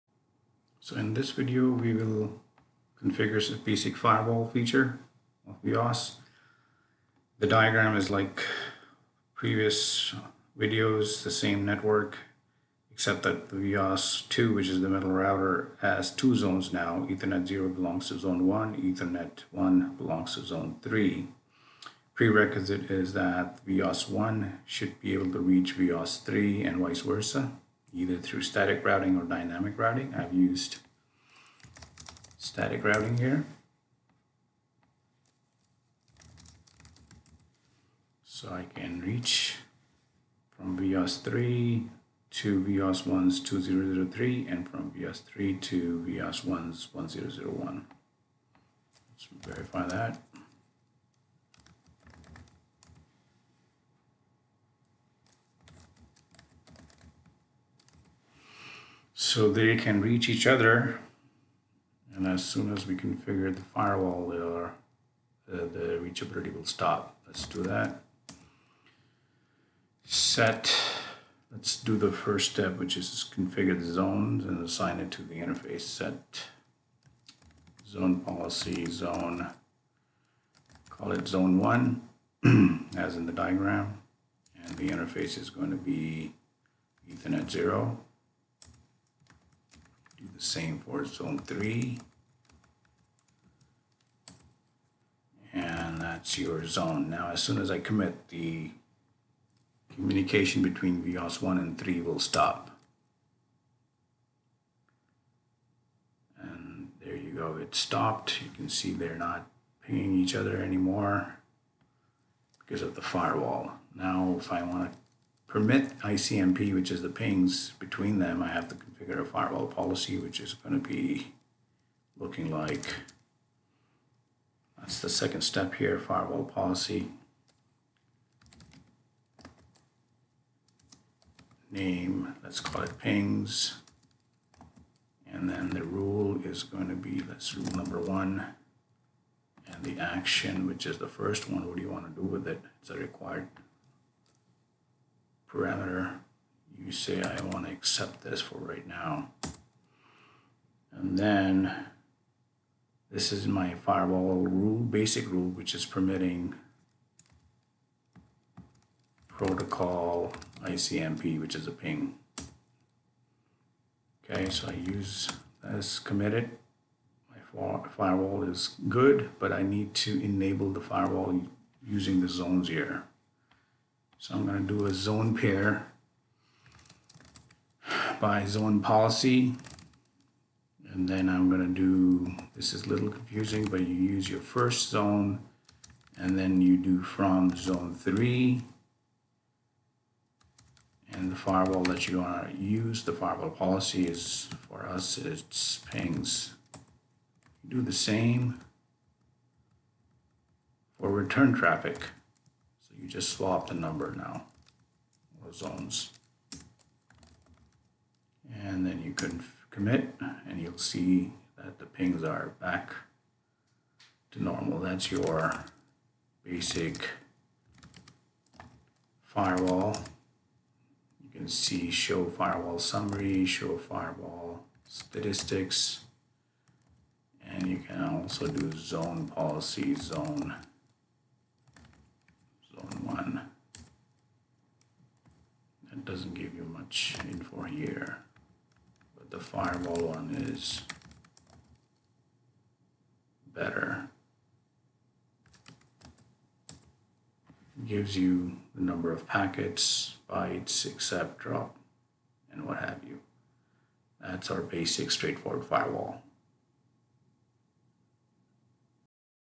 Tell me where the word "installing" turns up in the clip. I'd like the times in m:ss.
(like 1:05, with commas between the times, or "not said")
not said.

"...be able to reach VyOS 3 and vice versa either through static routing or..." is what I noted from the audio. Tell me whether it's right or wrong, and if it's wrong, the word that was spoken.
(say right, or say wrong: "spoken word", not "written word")
right.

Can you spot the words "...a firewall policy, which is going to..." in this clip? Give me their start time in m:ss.
1:59.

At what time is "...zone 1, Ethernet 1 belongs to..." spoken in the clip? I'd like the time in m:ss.
0:18.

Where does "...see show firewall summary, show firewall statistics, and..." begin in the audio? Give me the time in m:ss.
3:41.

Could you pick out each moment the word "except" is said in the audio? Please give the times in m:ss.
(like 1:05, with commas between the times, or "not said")
0:12.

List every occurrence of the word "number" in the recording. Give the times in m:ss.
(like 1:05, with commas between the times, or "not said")
2:17, 3:23, 4:08.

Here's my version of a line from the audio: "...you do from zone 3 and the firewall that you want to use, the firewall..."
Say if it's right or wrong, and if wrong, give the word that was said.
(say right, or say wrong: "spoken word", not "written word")
right.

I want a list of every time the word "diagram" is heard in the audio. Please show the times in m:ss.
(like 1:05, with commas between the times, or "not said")
0:07, 1:23.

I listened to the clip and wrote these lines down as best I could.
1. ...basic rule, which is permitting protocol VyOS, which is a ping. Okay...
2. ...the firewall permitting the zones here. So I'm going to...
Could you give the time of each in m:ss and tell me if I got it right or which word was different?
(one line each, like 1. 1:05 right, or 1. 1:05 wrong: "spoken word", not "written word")
1. 2:34 wrong: "ICMP", not "VyOS"
2. 2:50 wrong: "using", not "permitting".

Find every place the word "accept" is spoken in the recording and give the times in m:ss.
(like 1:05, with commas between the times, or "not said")
2:27, 4:10.